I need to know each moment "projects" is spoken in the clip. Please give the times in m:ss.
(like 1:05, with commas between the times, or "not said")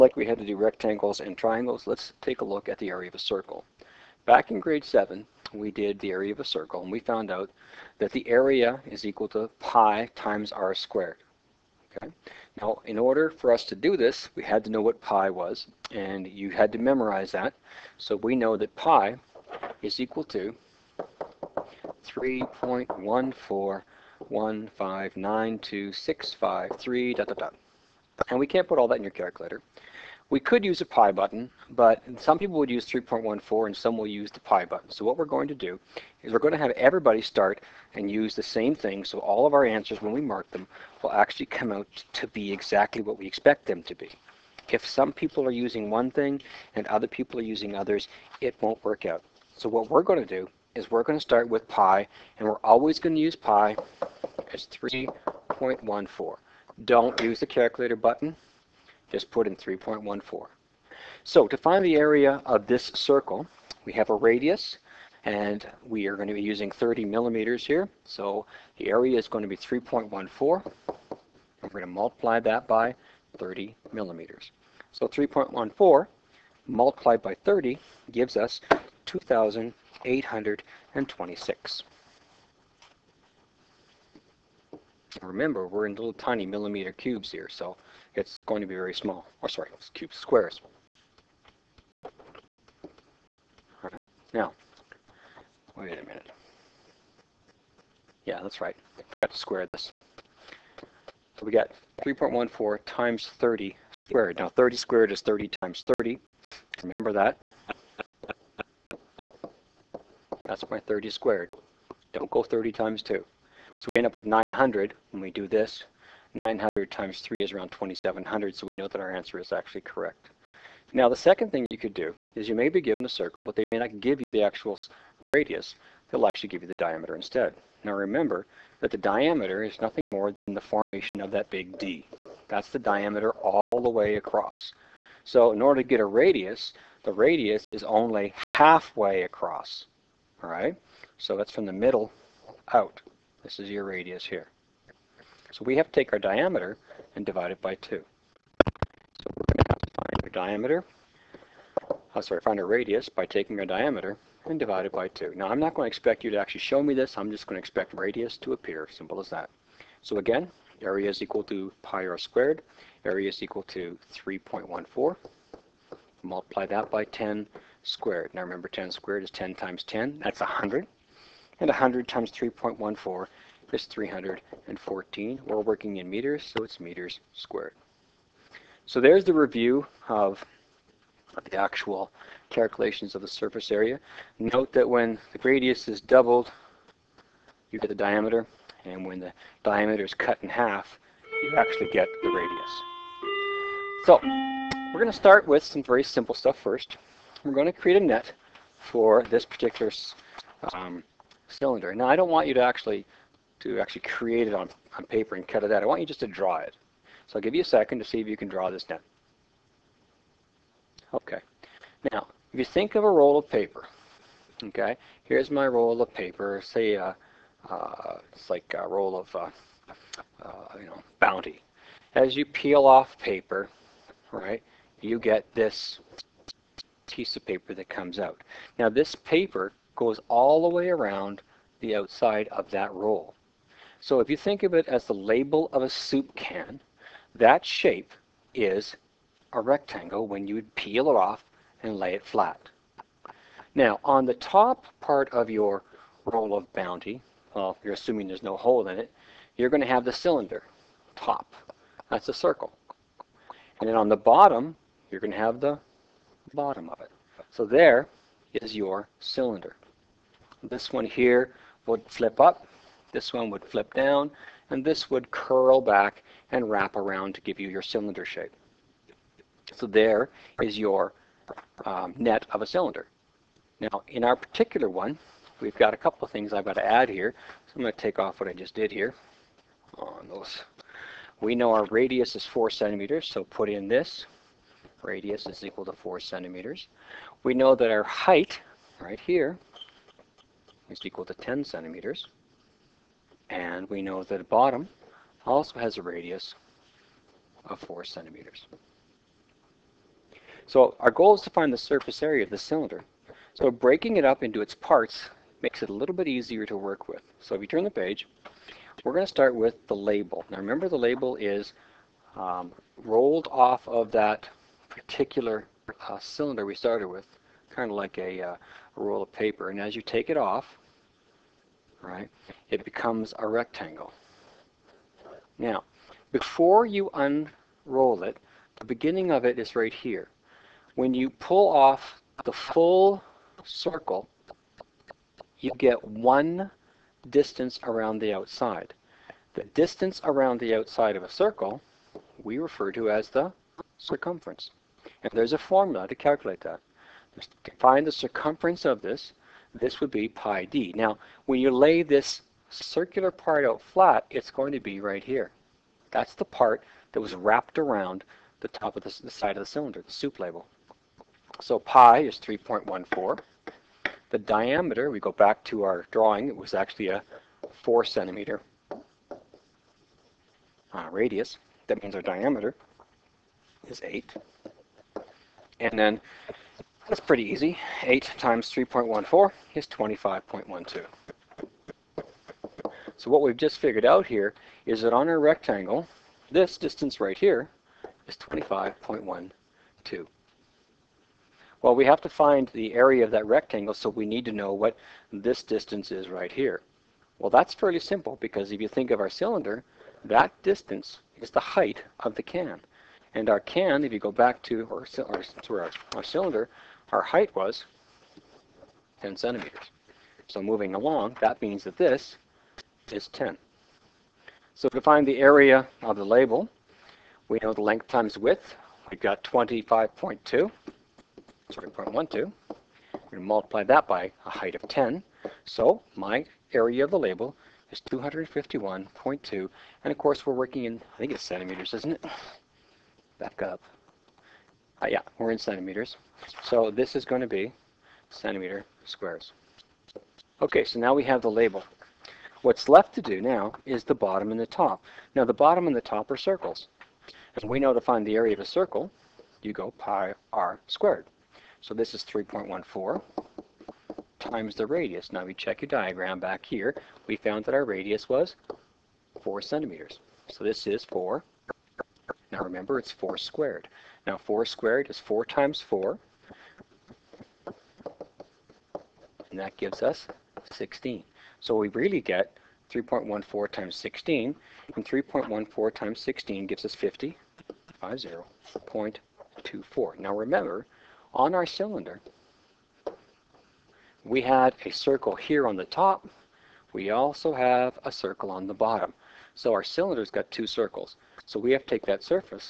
not said.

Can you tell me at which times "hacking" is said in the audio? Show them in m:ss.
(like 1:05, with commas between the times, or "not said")
not said.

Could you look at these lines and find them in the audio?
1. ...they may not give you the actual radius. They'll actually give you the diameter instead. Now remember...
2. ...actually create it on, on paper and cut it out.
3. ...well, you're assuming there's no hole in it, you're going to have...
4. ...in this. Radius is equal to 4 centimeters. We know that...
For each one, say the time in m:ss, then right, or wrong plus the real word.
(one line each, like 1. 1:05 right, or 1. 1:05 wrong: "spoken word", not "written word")
1. 2:03 right
2. 3:23 right
3. 4:07 right
4. 4:43 right.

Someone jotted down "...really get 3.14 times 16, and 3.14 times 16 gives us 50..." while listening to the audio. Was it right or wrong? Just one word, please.
right.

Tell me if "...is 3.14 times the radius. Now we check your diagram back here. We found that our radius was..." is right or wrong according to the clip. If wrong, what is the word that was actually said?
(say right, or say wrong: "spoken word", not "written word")
right.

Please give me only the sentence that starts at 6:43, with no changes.
And our can, if you go back to our, our, our, our cylinder, our height was 10 centimeters.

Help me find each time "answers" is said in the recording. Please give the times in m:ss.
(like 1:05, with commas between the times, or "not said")
0:39, 1:59.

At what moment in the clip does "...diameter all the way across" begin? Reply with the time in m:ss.
2:12.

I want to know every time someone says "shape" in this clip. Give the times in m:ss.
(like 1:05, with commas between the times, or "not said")
3:57, 4:28.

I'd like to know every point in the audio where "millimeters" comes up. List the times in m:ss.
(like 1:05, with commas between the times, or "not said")
1:07, 1:13, 1:26.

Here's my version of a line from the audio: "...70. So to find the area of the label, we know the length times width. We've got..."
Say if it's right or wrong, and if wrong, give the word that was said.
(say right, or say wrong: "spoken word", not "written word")
wrong: "10", not "70".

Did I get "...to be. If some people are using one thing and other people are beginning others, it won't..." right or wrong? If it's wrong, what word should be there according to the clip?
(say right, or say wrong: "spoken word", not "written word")
wrong: "using", not "beginning".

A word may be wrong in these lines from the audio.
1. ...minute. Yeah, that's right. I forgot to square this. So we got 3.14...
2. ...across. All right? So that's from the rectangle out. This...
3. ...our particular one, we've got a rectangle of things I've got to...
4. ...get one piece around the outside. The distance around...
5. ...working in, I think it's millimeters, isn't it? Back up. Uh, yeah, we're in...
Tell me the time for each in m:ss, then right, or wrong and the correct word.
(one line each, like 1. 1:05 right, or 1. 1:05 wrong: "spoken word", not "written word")
1. 1:36 right
2. 2:19 wrong: "middle", not "rectangle"
3. 4:34 wrong: "couple", not "rectangle"
4. 5:35 wrong: "distance", not "piece"
5. 7:10 wrong: "centimeters", not "millimeters".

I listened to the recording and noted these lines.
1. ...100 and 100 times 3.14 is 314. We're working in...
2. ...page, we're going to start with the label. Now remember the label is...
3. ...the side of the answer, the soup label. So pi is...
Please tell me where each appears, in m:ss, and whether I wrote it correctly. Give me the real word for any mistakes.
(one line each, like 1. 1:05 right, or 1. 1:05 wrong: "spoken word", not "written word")
1. 2:50 right
2. 5:07 right
3. 5:59 wrong: "cylinder", not "answer".